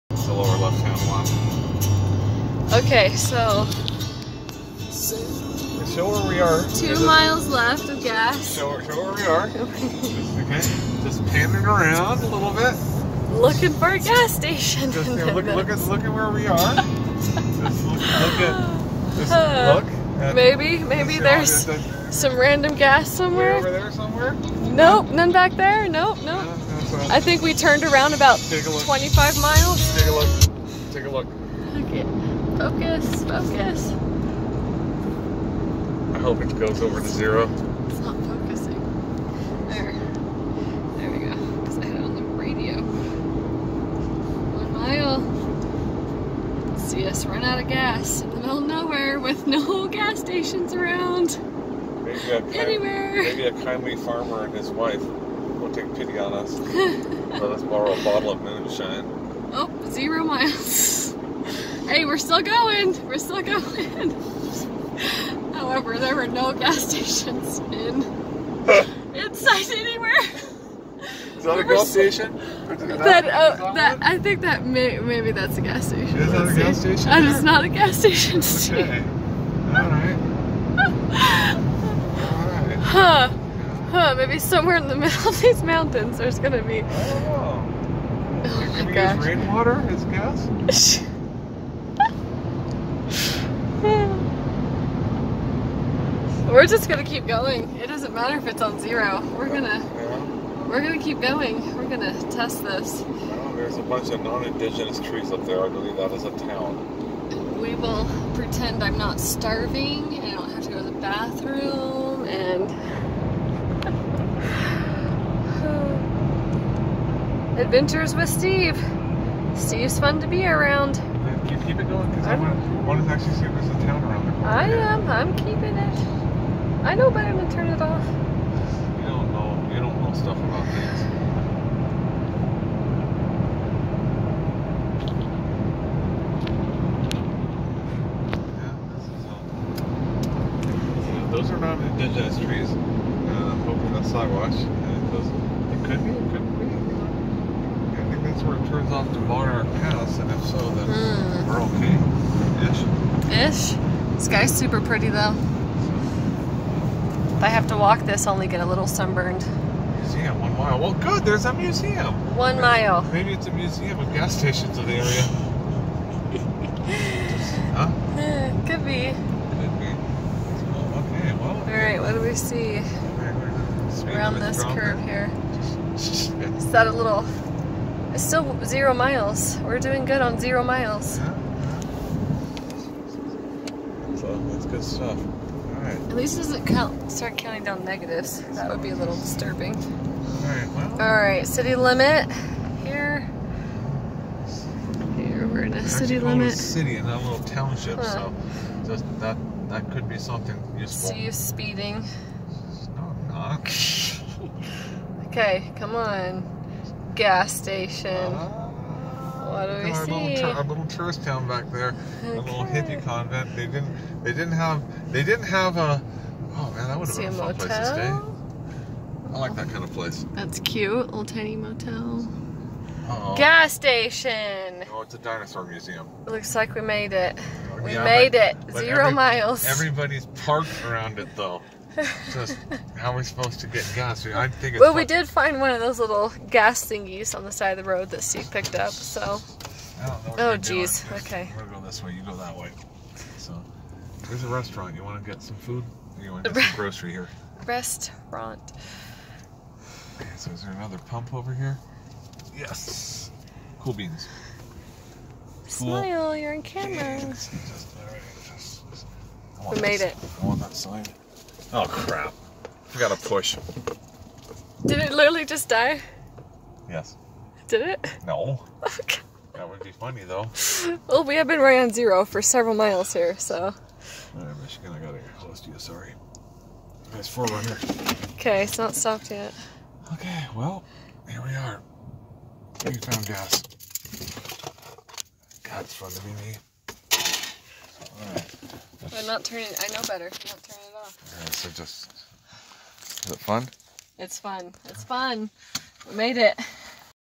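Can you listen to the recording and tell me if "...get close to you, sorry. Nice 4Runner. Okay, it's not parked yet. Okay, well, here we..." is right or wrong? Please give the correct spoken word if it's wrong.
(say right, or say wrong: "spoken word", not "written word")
wrong: "stopped", not "parked".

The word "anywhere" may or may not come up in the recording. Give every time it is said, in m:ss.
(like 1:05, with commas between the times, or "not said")
0:52, 1:09.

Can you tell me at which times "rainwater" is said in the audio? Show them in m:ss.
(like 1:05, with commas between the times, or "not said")
1:29.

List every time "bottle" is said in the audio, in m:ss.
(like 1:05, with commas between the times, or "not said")
0:58.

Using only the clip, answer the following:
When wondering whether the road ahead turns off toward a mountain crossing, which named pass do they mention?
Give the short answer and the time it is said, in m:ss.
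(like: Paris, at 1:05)
Monarch Pass, at 2:29.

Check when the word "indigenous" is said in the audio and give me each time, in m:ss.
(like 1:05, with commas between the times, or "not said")
1:44, 2:21.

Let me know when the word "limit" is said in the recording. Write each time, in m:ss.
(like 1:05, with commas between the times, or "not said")
3:11, 3:16.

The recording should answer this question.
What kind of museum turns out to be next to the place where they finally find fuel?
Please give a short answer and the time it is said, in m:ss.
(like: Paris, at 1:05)
Dinosaur museum, at 3:45.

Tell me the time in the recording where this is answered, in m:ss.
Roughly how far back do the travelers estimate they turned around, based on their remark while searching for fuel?
0:28.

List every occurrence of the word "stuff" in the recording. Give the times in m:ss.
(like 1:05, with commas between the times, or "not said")
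2:10, 3:04.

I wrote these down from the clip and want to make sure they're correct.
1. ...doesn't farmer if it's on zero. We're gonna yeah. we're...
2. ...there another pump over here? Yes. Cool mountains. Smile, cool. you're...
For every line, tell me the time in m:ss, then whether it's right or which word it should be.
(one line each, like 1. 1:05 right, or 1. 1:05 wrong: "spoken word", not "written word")
1. 1:37 wrong: "matter", not "farmer"
2. 4:10 wrong: "beans", not "mountains".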